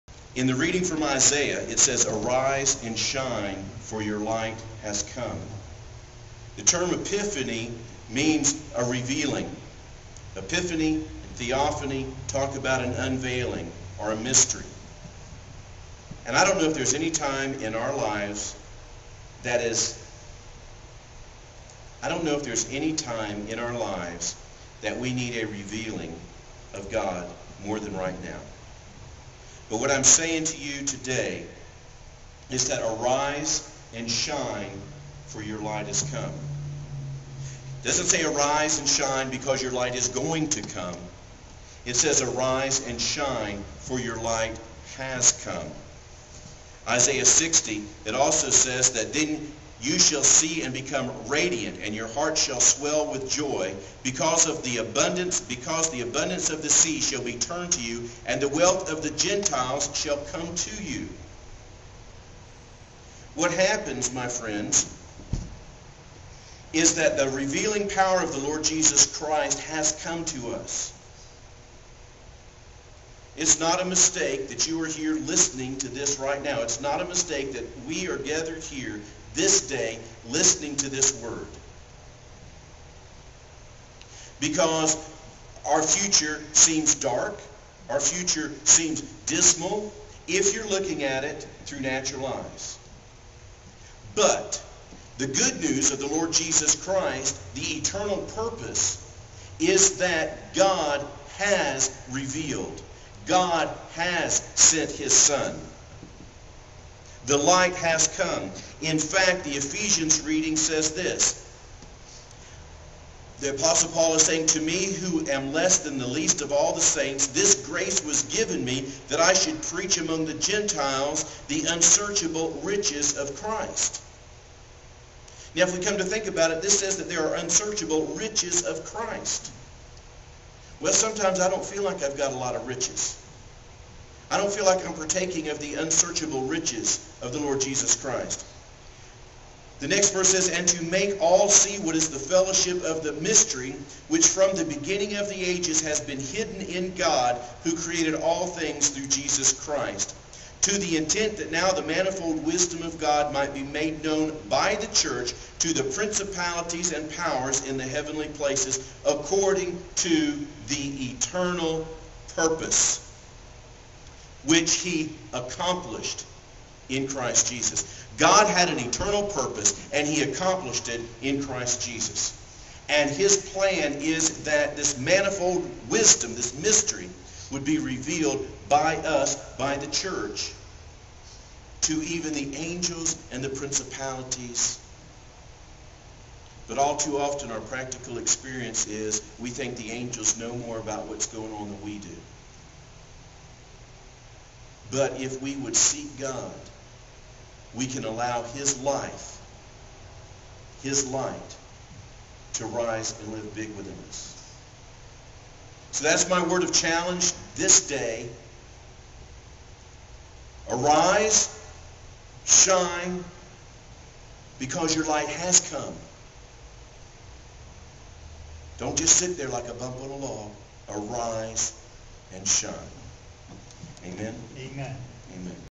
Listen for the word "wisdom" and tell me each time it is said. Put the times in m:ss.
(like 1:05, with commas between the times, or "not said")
2:32, 2:55.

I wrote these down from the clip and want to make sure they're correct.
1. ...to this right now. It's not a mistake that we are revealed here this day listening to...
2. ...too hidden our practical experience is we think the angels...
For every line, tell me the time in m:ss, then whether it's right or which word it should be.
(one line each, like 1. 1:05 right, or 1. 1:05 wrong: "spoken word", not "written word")
1. 1:15 wrong: "gathered", not "revealed"
2. 3:06 wrong: "often", not "hidden".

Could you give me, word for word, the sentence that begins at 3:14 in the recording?
But if we would seek God, we can allow his life, his light, to rise and live big within us.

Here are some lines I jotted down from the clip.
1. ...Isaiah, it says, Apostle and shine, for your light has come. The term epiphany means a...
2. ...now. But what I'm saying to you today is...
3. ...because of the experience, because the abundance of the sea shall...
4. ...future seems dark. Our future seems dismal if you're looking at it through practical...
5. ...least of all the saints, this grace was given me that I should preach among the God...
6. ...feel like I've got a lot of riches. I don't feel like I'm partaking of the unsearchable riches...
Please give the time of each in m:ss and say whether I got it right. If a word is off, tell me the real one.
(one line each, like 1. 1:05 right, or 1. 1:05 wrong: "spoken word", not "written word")
1. 0:01 wrong: "Arise", not "Apostle"
2. 0:28 right
3. 0:54 wrong: "abundance", not "experience"
4. 1:25 wrong: "natural", not "practical"
5. 1:56 wrong: "Gentiles", not "God"
6. 2:11 right.